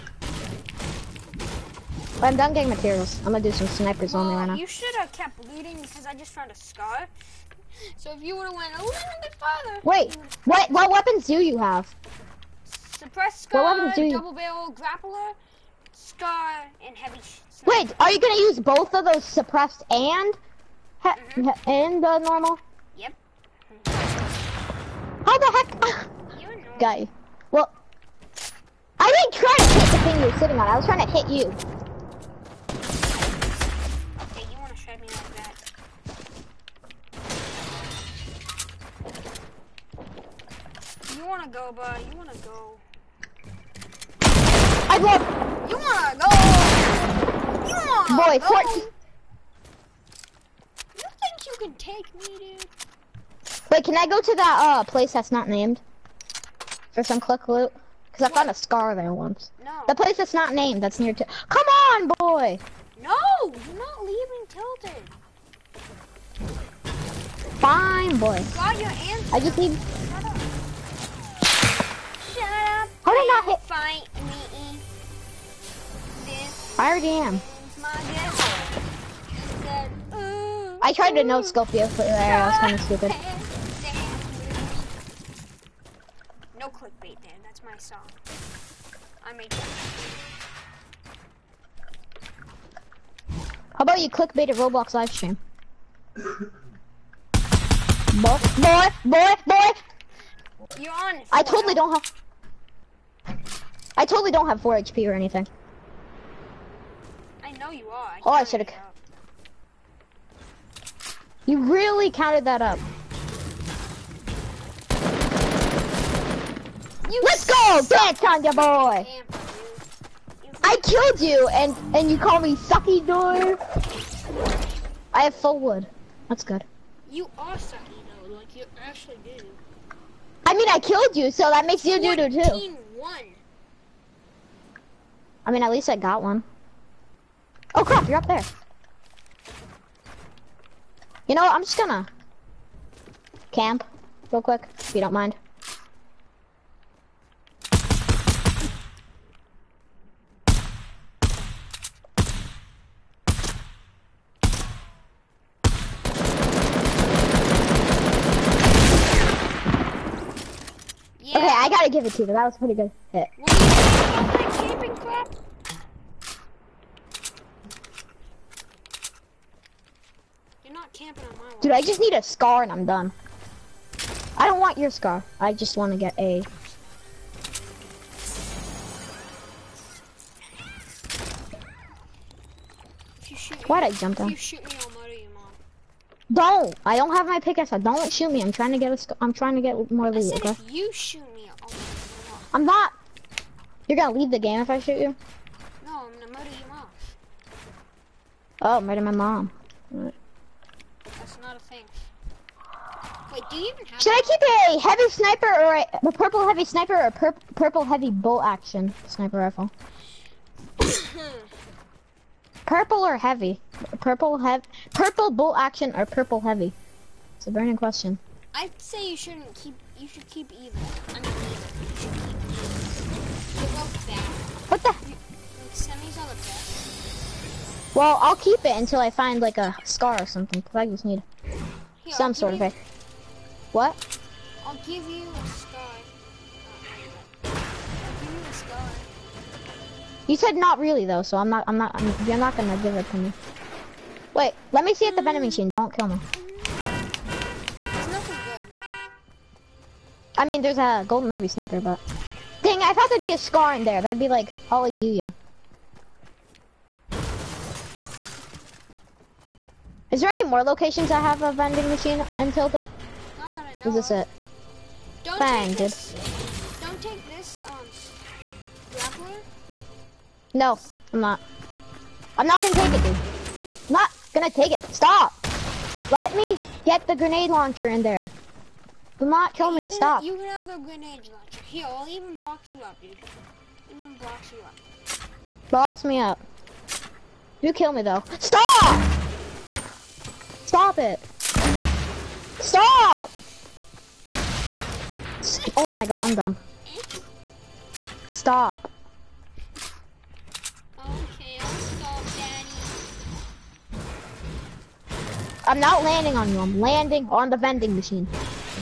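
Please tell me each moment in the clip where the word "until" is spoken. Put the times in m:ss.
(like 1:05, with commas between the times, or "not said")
3:48.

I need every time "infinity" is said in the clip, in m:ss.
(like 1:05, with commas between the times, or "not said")
not said.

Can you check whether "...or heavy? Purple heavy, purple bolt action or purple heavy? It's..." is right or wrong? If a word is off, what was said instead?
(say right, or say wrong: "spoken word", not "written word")
right.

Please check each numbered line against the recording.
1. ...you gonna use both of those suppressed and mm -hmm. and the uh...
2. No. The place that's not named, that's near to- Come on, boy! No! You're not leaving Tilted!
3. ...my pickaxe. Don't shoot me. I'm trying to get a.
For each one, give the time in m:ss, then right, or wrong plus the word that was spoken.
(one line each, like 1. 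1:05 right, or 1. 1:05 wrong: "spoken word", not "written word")
1. 0:18 right
2. 0:59 right
3. 3:07 right.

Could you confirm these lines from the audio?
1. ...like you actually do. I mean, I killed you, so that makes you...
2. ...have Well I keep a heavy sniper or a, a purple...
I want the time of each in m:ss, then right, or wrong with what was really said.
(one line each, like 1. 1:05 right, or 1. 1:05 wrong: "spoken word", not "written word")
1. 2:08 right
2. 3:23 wrong: "Should", not "Well".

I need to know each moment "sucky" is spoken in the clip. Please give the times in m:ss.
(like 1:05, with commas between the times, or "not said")
2:02, 2:07.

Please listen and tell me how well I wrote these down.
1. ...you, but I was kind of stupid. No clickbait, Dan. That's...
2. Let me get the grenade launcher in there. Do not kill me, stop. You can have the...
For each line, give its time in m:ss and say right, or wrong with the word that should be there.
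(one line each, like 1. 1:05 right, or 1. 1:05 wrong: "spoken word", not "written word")
1. 1:21 right
2. 4:36 right.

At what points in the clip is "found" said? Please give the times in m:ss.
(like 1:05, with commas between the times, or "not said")
0:06, 0:58.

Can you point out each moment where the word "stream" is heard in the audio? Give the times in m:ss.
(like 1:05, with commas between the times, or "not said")
1:35.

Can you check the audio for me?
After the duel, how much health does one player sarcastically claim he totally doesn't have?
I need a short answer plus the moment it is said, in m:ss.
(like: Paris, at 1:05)
4 HP, at 1:44.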